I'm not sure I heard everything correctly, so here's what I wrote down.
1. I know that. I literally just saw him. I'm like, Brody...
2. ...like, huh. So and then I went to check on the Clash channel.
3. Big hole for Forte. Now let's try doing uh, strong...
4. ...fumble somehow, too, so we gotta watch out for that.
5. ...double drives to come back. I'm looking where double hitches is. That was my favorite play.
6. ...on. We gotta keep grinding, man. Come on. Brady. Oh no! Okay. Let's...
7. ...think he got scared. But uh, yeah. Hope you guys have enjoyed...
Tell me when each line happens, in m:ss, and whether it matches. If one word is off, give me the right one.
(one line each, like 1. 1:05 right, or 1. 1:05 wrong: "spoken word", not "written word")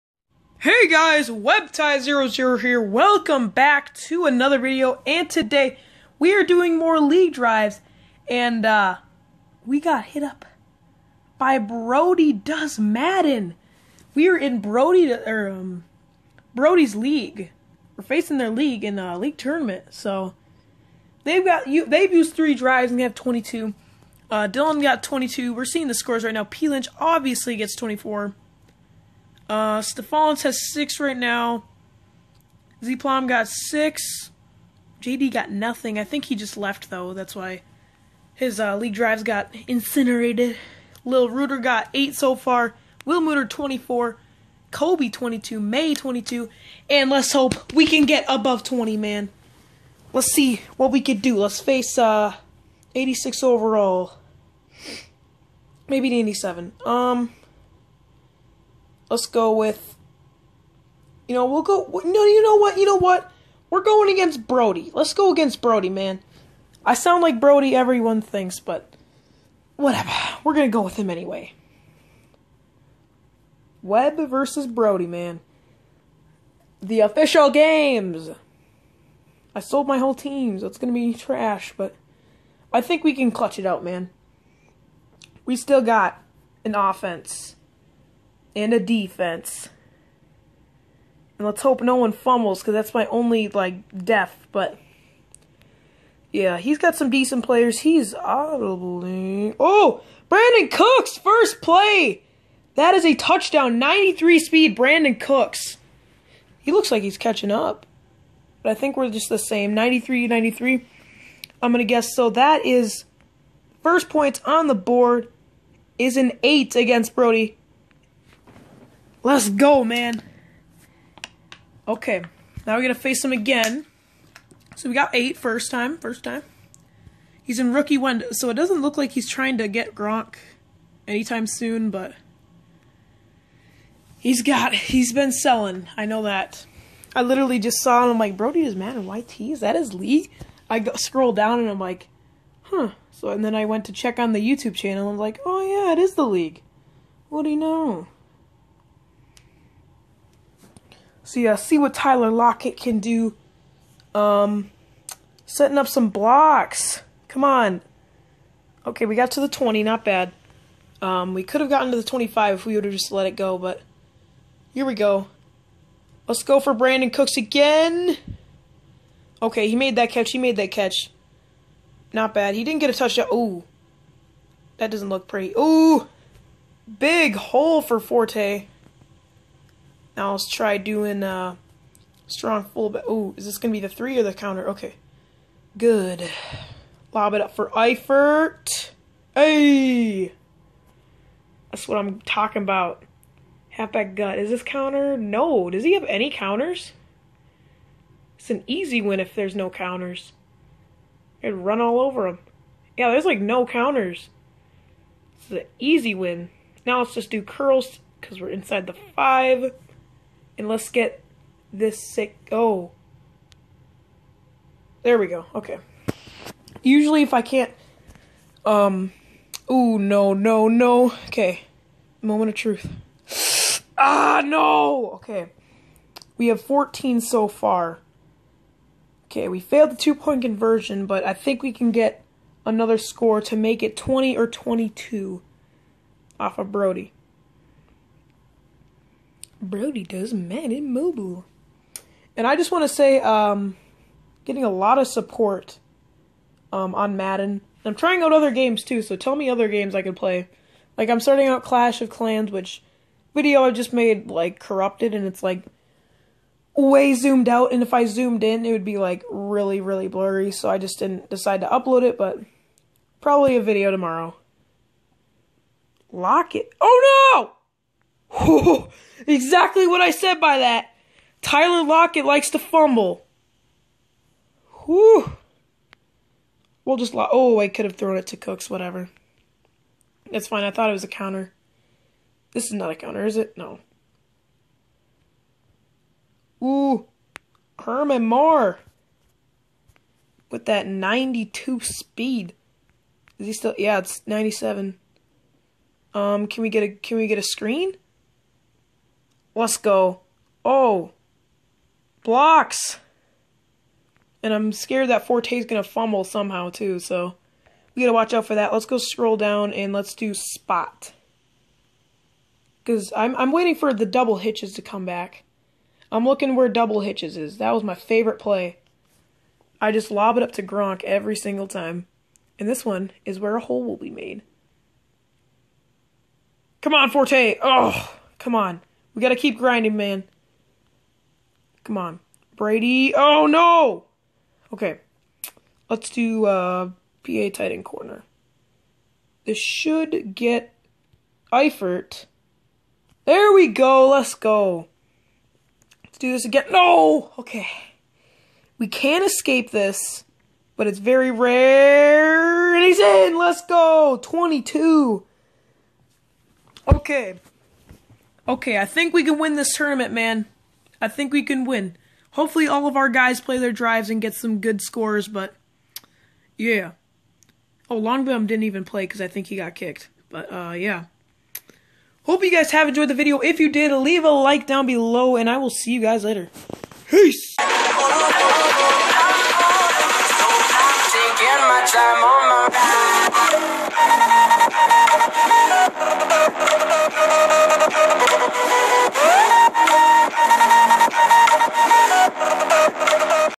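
1. 2:15 right
2. 2:21 wrong: "YouTube", not "Clash"
3. 2:56 right
4. 5:05 right
5. 5:14 wrong: "hitches", not "drives"
6. 5:28 right
7. 6:09 wrong: "kicked", not "scared".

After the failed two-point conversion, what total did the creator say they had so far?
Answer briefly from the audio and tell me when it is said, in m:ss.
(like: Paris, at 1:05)
14, at 3:46.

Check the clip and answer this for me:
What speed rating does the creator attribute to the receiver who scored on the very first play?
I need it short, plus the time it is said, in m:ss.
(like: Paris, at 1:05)
93, at 1:43.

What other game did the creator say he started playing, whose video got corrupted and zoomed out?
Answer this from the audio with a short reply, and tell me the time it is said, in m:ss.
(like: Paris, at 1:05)
Clash of Clans, at 4:11.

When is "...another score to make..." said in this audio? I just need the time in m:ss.
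3:52.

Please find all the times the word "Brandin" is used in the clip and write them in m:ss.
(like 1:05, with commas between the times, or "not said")
1:40, 1:44, 2:46.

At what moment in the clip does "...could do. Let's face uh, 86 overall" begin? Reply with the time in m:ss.
0:51.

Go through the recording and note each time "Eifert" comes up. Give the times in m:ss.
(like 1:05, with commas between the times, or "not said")
3:07, 5:41.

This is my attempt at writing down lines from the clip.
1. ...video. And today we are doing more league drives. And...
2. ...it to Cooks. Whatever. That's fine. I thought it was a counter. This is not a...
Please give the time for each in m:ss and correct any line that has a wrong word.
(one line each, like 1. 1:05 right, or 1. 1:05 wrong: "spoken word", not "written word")
1. 0:04 right
2. 4:38 right.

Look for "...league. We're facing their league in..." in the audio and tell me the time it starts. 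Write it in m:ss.
0:16.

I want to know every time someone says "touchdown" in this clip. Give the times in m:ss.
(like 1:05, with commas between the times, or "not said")
1:43, 2:52.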